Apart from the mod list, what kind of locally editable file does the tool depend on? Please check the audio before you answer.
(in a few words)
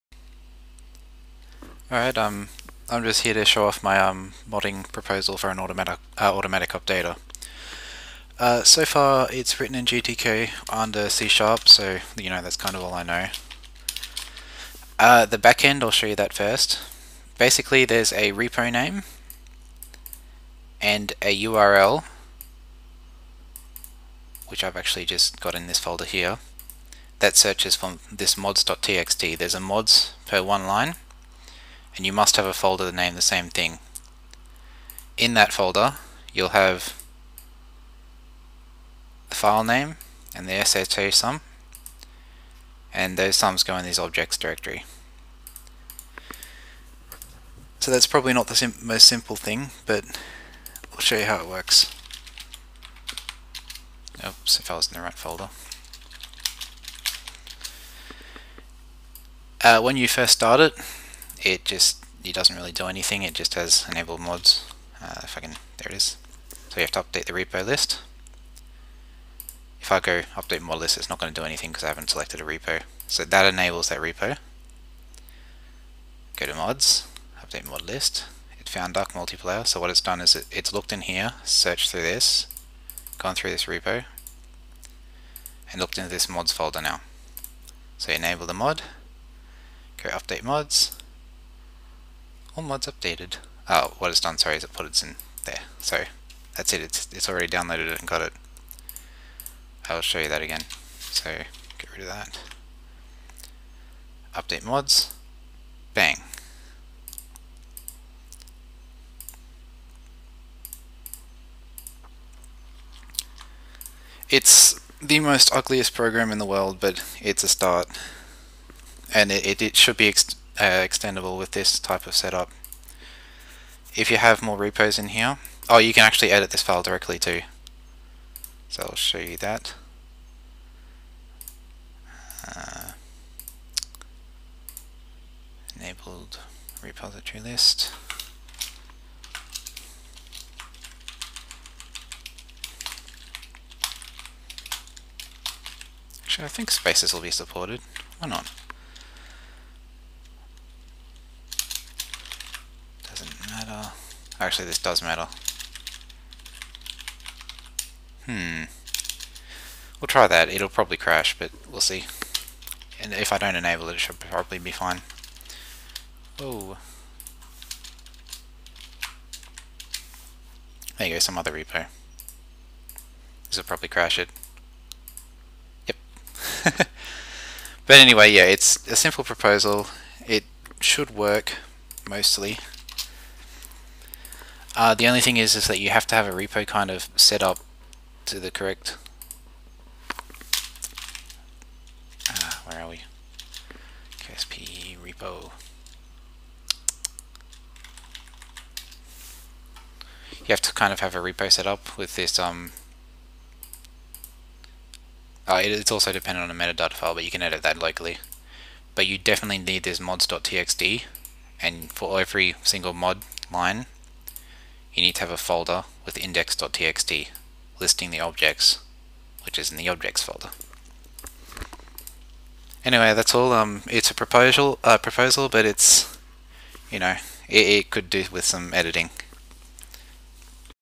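metadata file.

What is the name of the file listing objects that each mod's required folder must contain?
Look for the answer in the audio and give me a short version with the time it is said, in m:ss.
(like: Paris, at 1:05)
index.txt, at 3:36.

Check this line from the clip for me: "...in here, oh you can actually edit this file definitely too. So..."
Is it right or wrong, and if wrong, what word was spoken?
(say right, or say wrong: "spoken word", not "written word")
wrong: "directly", not "definitely".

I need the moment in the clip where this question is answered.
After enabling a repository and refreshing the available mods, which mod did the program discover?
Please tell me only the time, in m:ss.
1:18.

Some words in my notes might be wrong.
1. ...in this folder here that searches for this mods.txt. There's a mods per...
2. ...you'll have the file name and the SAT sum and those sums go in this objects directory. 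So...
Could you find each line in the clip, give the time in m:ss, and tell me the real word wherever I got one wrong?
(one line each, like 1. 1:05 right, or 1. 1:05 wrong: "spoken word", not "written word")
1. 0:25 right
2. 0:36 right.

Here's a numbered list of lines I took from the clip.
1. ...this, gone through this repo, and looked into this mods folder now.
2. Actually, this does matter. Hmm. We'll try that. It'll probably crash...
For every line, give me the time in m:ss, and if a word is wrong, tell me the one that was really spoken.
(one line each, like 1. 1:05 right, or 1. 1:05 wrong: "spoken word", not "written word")
1. 1:22 right
2. 2:34 right.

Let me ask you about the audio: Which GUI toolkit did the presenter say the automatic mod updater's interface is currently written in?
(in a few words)
GTK.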